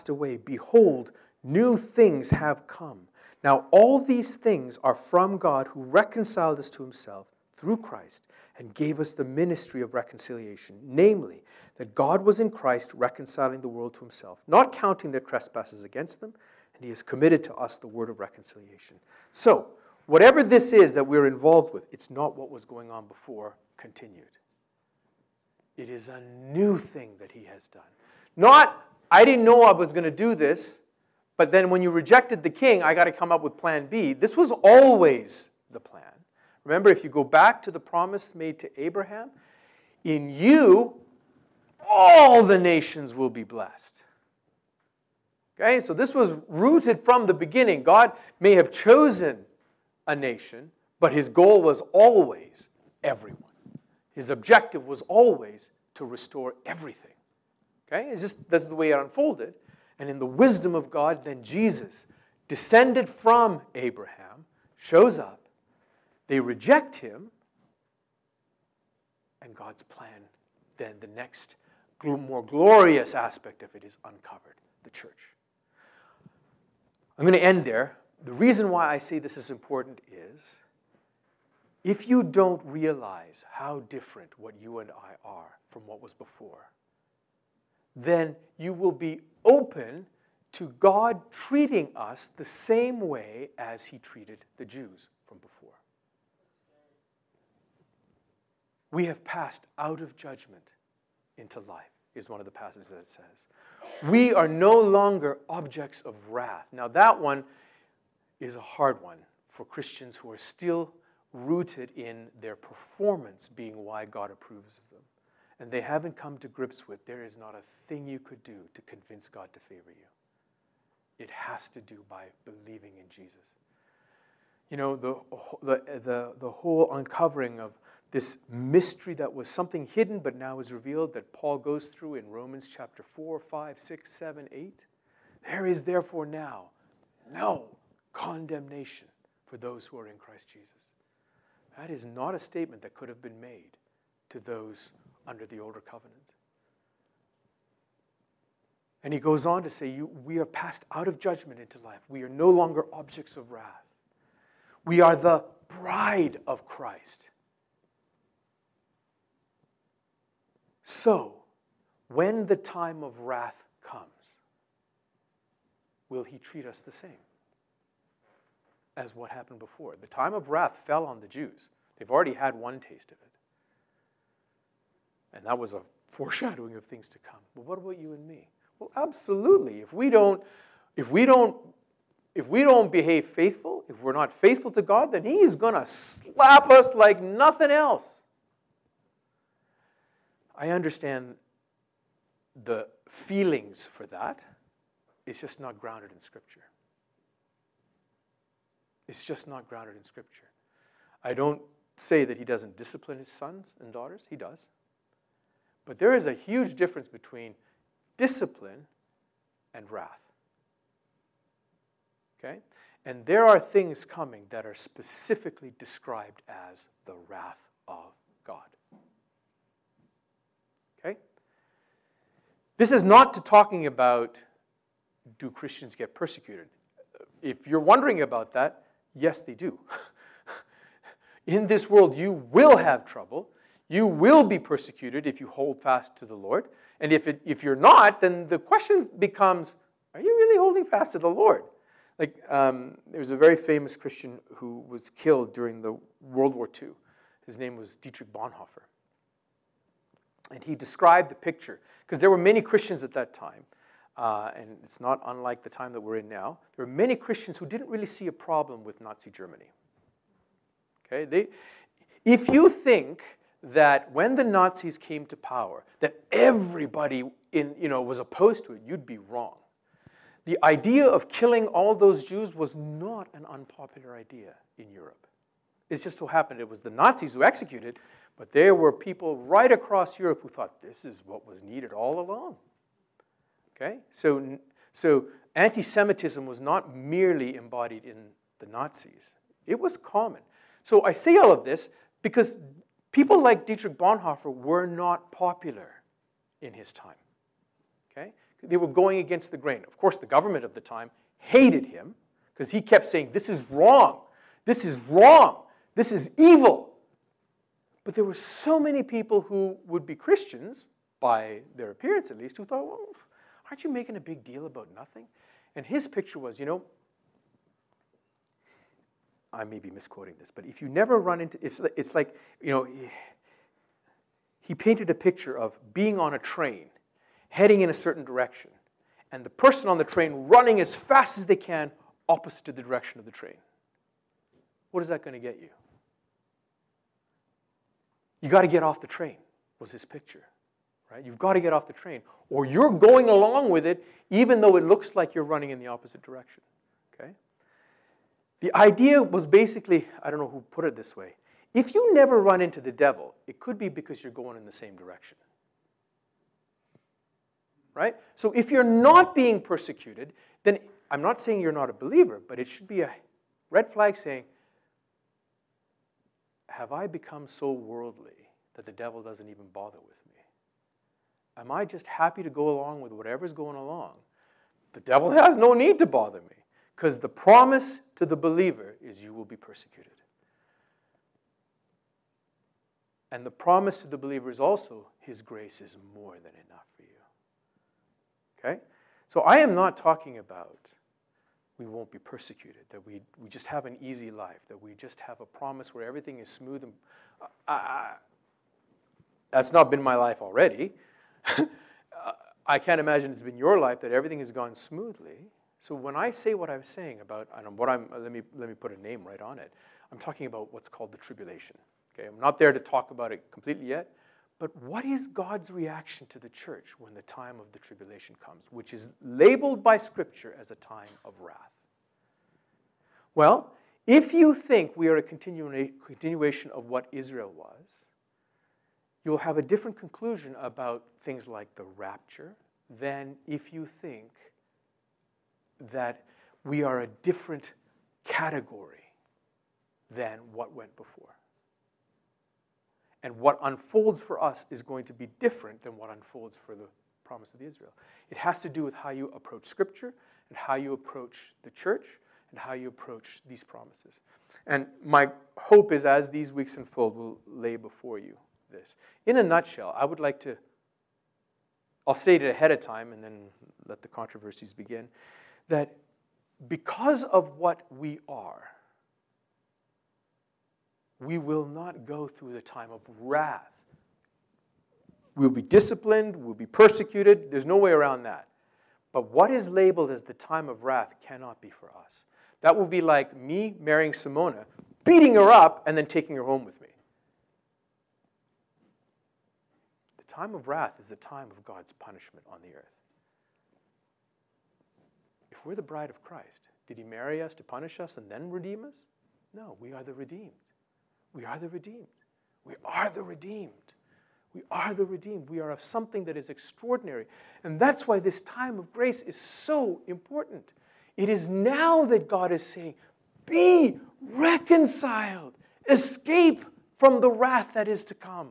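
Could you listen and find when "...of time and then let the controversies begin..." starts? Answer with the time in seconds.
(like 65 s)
462 s.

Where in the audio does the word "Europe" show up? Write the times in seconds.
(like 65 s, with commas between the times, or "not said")
274 s, 280 s.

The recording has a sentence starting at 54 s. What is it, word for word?
His objective was always to restore everything.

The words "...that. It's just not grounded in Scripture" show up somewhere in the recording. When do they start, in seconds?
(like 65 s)
194 s.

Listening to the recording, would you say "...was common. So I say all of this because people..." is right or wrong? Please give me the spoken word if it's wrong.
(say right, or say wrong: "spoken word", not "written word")
right.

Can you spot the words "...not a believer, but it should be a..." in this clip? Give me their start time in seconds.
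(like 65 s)
361 s.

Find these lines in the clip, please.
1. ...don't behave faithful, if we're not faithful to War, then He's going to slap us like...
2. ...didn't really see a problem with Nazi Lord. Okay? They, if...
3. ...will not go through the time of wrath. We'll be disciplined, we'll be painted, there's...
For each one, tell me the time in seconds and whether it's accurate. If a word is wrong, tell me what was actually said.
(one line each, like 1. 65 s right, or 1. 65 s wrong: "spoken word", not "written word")
1. 182 s wrong: "God", not "War"
2. 257 s wrong: "Germany", not "Lord"
3. 471 s wrong: "persecuted", not "painted".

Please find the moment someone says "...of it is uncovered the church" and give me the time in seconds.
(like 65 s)
73 s.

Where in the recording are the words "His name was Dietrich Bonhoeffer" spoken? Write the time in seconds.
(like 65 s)
247 s.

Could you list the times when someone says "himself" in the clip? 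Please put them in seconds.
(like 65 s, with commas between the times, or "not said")
6 s, 13 s.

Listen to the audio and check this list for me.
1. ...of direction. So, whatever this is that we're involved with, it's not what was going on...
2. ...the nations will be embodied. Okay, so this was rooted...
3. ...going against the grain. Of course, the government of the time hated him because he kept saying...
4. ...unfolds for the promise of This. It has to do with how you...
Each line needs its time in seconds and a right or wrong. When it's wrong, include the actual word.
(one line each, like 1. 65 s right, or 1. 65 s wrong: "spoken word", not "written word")
1. 18 s wrong: "reconciliation", not "direction"
2. 42 s wrong: "blessed", not "embodied"
3. 298 s right
4. 446 s wrong: "Israel", not "This".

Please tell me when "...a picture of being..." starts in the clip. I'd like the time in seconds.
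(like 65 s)
325 s.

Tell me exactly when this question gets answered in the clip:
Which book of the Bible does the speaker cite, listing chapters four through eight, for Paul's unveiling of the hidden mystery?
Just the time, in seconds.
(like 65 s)
132 s.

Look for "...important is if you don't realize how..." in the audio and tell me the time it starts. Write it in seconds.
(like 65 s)
79 s.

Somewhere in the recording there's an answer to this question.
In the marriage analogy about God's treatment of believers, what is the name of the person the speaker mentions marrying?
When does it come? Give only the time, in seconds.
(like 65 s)
484 s.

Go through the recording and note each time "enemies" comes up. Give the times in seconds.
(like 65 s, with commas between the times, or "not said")
not said.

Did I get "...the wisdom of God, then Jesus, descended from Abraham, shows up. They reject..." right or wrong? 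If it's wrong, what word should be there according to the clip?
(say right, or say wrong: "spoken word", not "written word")
right.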